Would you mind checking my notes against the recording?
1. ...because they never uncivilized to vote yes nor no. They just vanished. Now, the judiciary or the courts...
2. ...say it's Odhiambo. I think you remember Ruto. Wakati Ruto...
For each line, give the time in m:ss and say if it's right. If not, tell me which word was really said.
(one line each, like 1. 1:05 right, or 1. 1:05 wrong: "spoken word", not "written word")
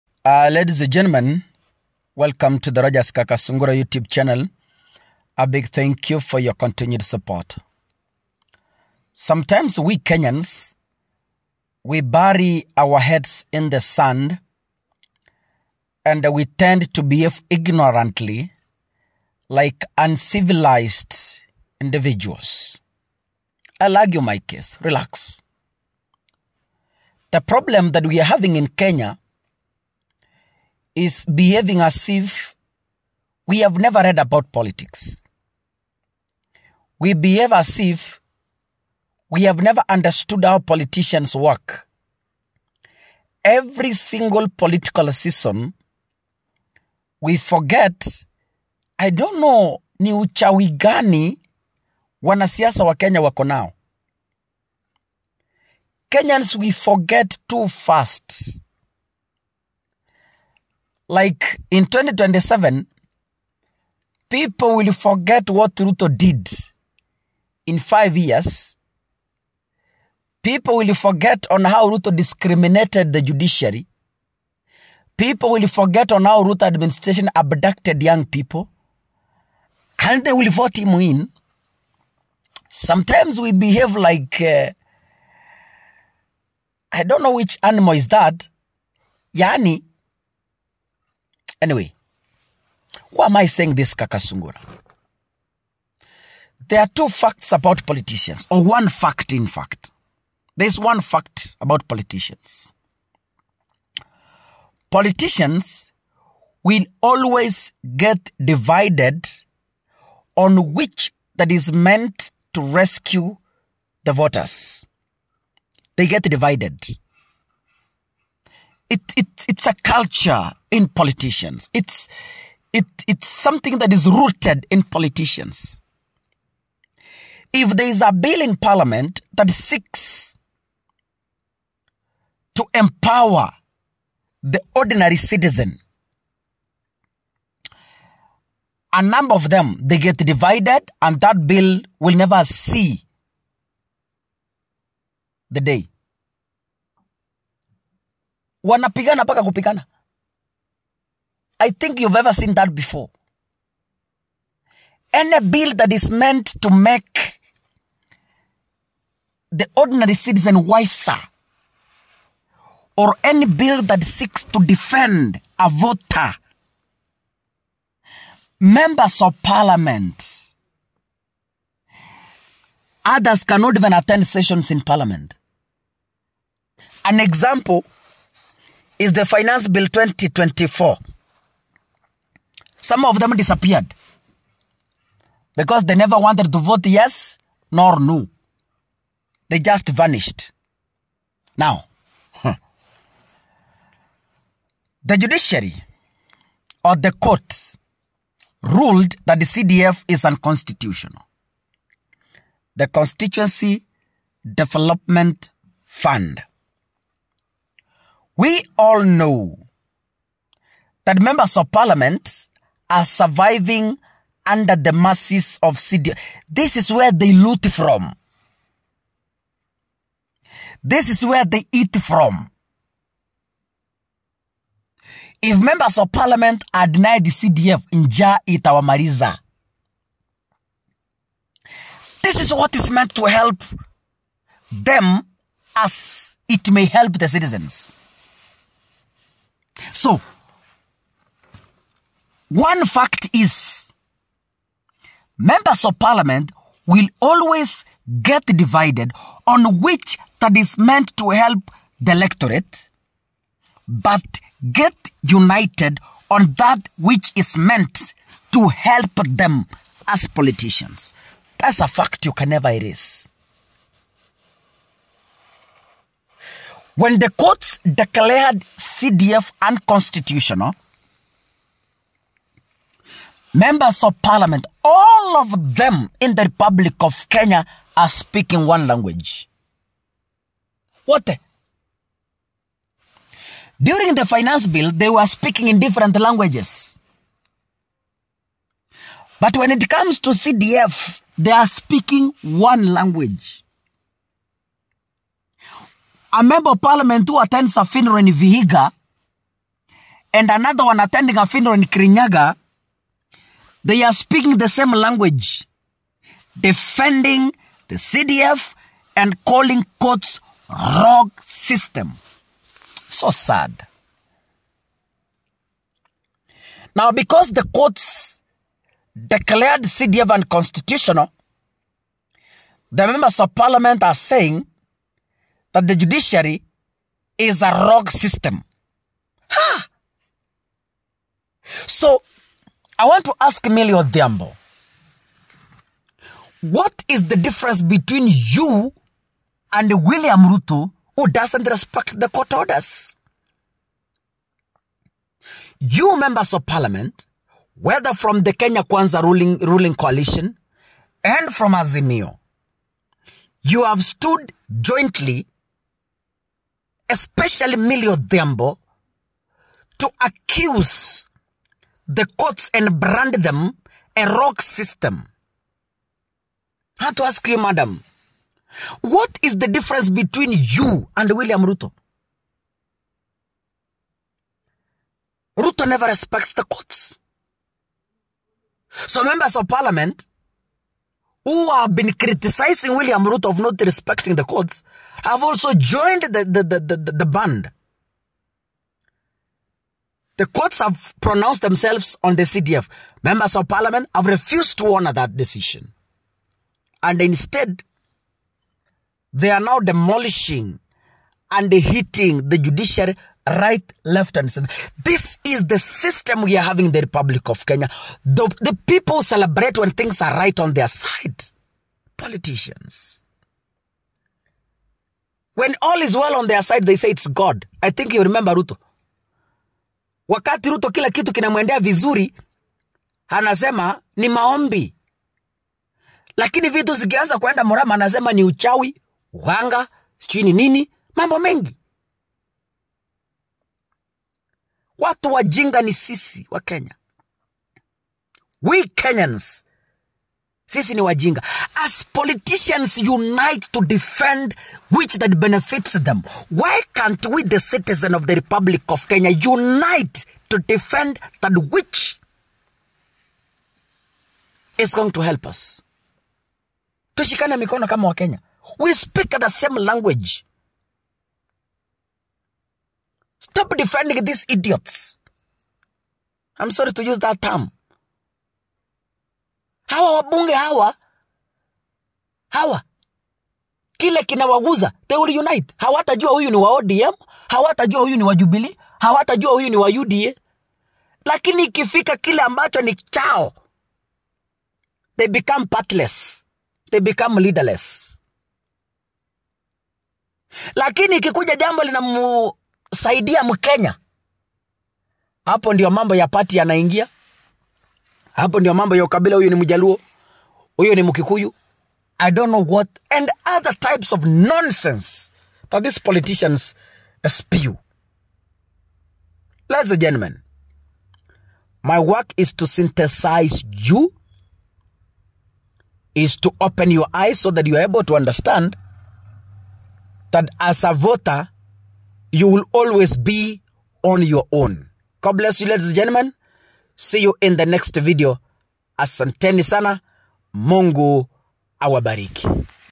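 1. 3:05 wrong: "wanted", not "uncivilized"
2. 6:56 wrong: "God", not "Odhiambo".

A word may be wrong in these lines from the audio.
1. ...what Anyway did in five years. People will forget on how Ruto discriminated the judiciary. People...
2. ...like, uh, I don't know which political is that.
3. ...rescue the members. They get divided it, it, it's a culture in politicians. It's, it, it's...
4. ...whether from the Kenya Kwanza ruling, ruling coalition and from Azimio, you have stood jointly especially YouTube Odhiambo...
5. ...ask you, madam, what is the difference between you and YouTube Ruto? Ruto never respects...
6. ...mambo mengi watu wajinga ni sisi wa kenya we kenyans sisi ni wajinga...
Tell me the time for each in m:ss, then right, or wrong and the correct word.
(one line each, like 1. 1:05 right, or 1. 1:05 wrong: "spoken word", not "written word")
1. 1:05 wrong: "Ruto", not "Anyway"
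2. 1:23 wrong: "animal", not "political"
3. 1:52 wrong: "voters", not "members"
4. 5:47 wrong: "Millie", not "YouTube"
5. 6:07 wrong: "William", not "YouTube"
6. 7:11 right.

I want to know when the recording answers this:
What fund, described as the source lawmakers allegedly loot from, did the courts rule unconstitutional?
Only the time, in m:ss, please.
3:22.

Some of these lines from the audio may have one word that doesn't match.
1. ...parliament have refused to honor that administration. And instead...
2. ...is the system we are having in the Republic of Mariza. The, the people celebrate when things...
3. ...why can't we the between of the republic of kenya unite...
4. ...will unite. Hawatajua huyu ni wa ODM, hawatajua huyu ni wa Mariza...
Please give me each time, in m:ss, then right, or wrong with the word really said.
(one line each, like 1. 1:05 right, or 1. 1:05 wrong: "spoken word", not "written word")
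1. 6:33 wrong: "decision", not "administration"
2. 6:45 wrong: "Kenya", not "Mariza"
3. 7:26 wrong: "citizen", not "between"
4. 7:55 wrong: "Jubilee", not "Mariza".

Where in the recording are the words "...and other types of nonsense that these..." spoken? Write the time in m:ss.
8:23.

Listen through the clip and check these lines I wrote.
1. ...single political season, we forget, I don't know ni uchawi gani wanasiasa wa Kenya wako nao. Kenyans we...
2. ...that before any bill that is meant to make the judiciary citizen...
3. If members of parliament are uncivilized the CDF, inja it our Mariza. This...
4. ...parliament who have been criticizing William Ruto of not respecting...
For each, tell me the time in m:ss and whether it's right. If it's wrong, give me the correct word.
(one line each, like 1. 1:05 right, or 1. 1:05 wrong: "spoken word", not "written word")
1. 0:43 right
2. 2:32 wrong: "ordinary", not "judiciary"
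3. 3:45 wrong: "denied", not "uncivilized"
4. 6:19 right.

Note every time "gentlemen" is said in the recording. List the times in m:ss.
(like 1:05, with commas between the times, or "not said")
0:00, 8:30, 8:45.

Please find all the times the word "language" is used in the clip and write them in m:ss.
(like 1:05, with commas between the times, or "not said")
4:38, 4:46, 4:52, 5:04, 7:39.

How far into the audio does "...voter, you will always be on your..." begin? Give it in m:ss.
8:40.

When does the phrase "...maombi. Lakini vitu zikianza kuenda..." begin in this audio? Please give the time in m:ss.
7:04.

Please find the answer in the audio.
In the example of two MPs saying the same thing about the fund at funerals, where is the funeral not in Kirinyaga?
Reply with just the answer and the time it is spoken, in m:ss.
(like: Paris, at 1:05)
Vihiga, at 4:58.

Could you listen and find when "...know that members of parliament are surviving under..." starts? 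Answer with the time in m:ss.
3:29.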